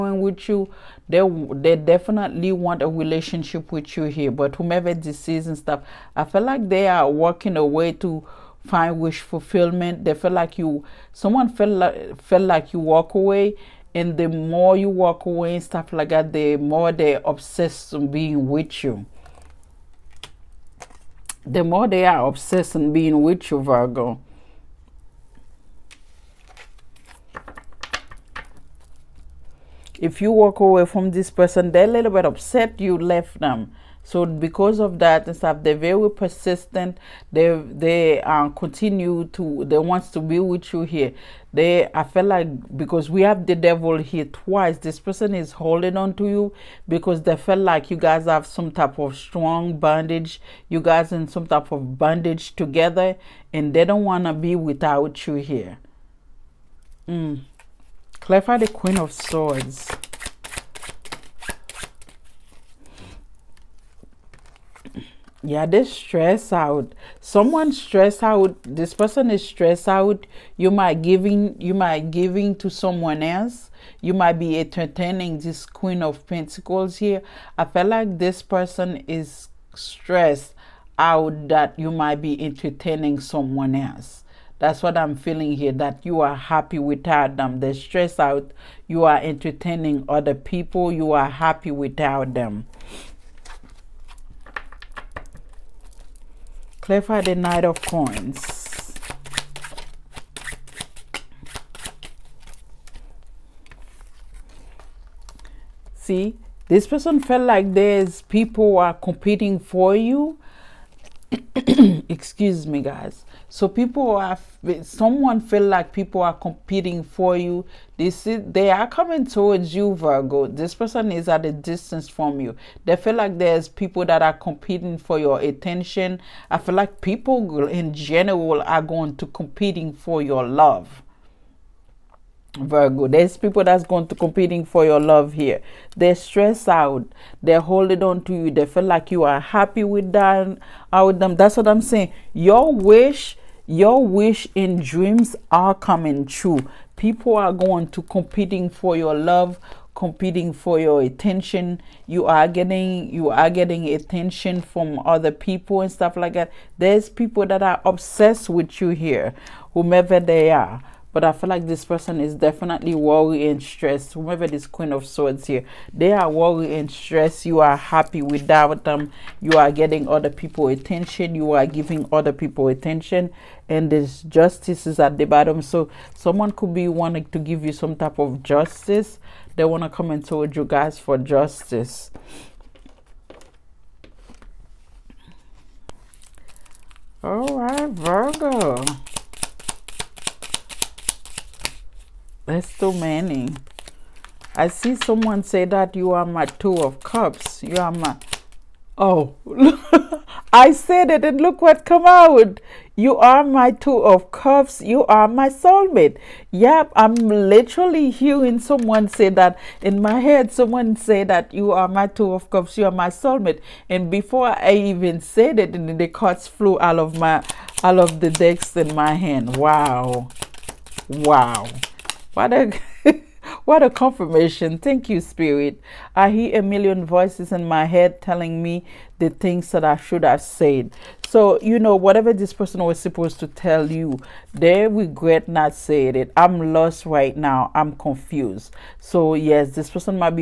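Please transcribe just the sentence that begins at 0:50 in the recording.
You guys in some type of bondage together, and they don't wanna be without you here.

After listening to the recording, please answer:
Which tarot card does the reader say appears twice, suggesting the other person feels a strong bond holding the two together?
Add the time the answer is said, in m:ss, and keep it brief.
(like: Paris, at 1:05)
The Devil, at 0:43.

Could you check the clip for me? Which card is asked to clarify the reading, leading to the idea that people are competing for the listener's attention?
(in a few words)
Knight of Coins.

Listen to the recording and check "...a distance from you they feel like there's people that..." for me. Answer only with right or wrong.
right.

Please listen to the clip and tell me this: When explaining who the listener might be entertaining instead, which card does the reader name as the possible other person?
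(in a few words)
Queen of Pentacles.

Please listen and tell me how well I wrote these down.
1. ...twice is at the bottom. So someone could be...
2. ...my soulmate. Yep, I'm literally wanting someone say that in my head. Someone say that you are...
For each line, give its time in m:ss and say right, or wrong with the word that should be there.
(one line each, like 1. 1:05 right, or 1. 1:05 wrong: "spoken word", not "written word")
1. 2:54 wrong: "justice", not "twice"
2. 3:25 wrong: "hearing", not "wanting".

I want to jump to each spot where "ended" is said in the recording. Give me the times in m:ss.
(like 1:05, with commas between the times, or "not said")
not said.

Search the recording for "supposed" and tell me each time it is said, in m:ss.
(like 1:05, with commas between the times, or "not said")
3:52.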